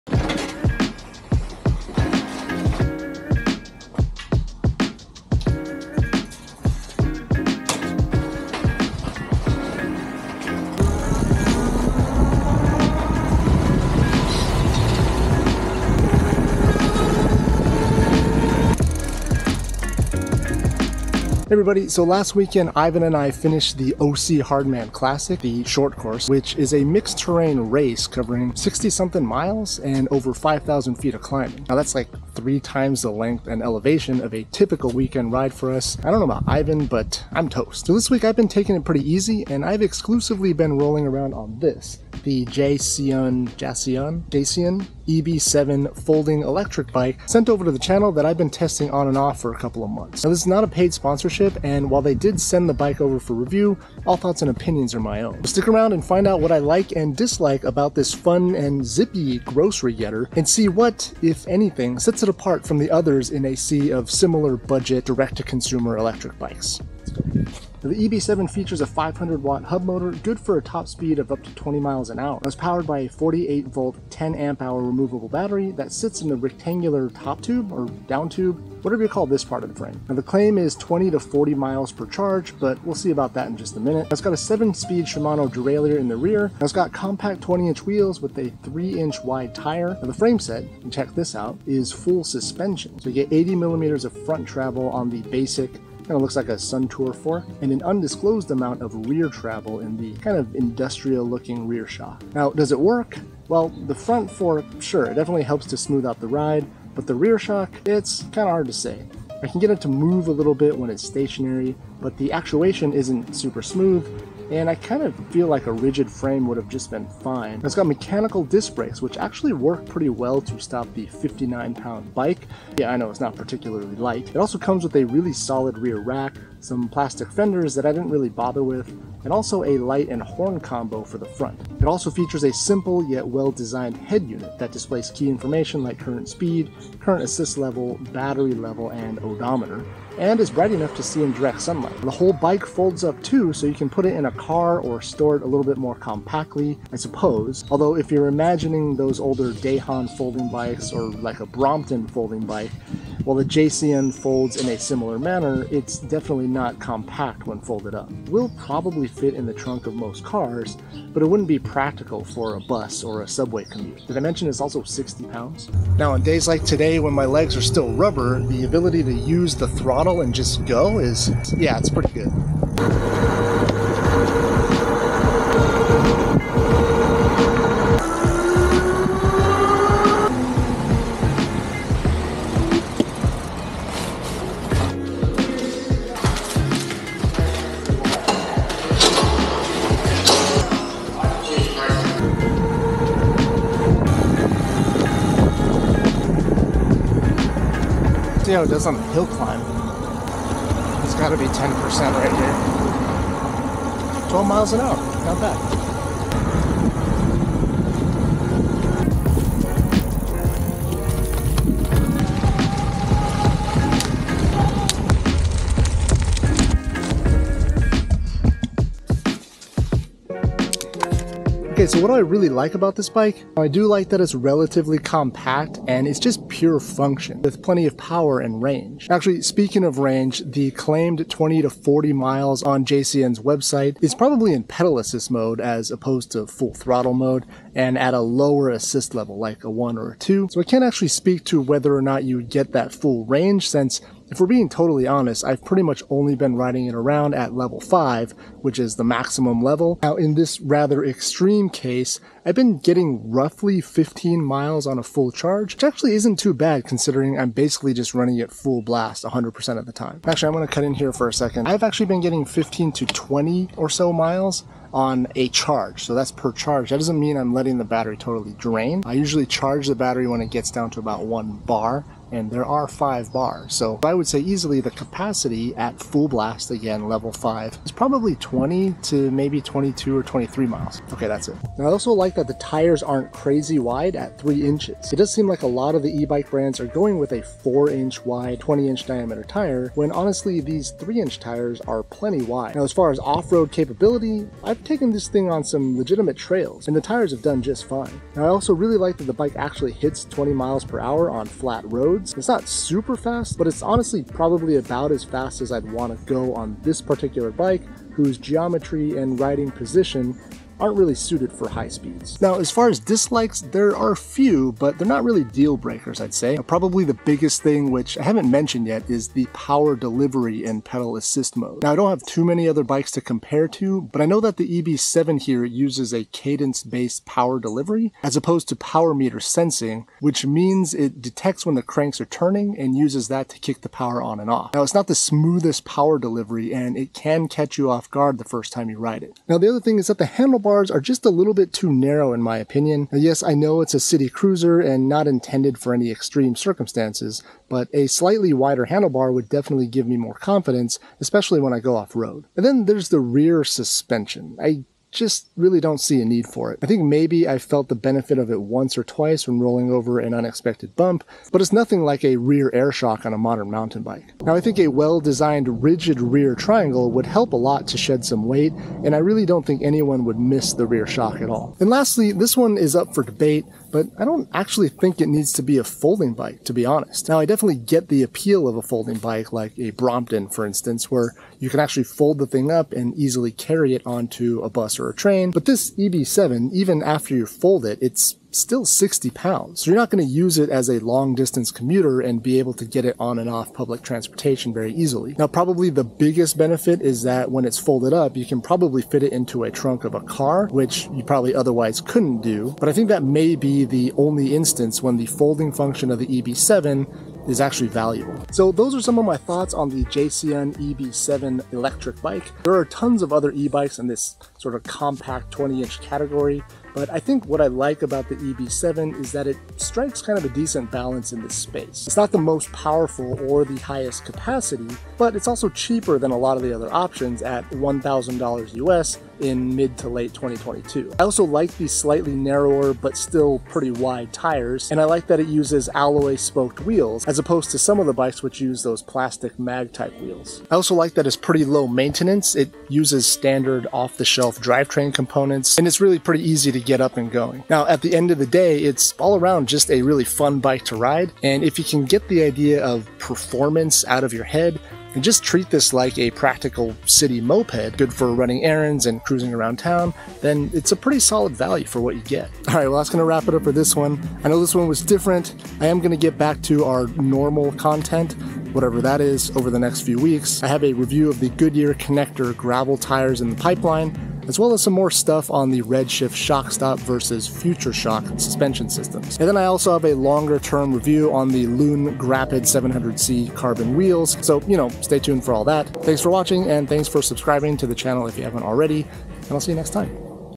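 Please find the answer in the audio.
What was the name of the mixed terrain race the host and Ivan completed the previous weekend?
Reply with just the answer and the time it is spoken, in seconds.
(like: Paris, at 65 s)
OC Hardman Classic, at 23 s.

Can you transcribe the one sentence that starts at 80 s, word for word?
Now the claim is 20 to 40 miles per charge, but we'll see about that in just a minute.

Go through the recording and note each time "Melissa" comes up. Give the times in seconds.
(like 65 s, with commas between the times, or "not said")
not said.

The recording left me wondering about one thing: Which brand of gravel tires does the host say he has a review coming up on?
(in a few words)
Goodyear Connector.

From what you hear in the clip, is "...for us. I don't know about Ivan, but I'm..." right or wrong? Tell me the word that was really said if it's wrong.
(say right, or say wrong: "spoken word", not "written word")
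right.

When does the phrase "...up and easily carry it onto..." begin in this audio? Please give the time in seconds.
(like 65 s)
382 s.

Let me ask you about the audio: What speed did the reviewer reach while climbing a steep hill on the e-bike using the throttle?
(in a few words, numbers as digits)
12 miles an hour.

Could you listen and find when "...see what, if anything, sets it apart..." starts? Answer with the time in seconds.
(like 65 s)
60 s.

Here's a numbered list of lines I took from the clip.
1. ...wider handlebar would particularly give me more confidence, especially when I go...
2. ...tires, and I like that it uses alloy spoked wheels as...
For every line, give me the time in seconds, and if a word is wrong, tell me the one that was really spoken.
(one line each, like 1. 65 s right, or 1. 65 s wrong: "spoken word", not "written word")
1. 348 s wrong: "definitely", not "particularly"
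2. 434 s right.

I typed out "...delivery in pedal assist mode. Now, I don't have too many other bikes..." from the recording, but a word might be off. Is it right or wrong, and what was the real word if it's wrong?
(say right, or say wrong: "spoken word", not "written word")
right.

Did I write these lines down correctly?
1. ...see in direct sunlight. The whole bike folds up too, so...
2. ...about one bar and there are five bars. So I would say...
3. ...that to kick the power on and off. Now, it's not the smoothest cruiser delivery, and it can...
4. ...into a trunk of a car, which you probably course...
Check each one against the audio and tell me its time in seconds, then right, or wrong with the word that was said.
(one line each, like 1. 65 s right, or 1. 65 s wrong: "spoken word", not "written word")
1. 141 s right
2. 271 s right
3. 333 s wrong: "power", not "cruiser"
4. 399 s wrong: "otherwise", not "course".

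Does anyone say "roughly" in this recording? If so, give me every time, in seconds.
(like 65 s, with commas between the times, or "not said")
253 s.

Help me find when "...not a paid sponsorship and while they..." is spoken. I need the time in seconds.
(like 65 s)
50 s.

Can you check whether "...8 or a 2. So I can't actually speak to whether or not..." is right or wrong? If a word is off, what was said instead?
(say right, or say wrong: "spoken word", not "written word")
wrong: "1", not "8".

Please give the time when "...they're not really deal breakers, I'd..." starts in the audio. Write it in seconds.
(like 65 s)
314 s.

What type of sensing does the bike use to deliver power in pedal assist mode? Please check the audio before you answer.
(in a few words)
cadence-based.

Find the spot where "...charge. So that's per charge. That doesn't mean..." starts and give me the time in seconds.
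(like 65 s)
265 s.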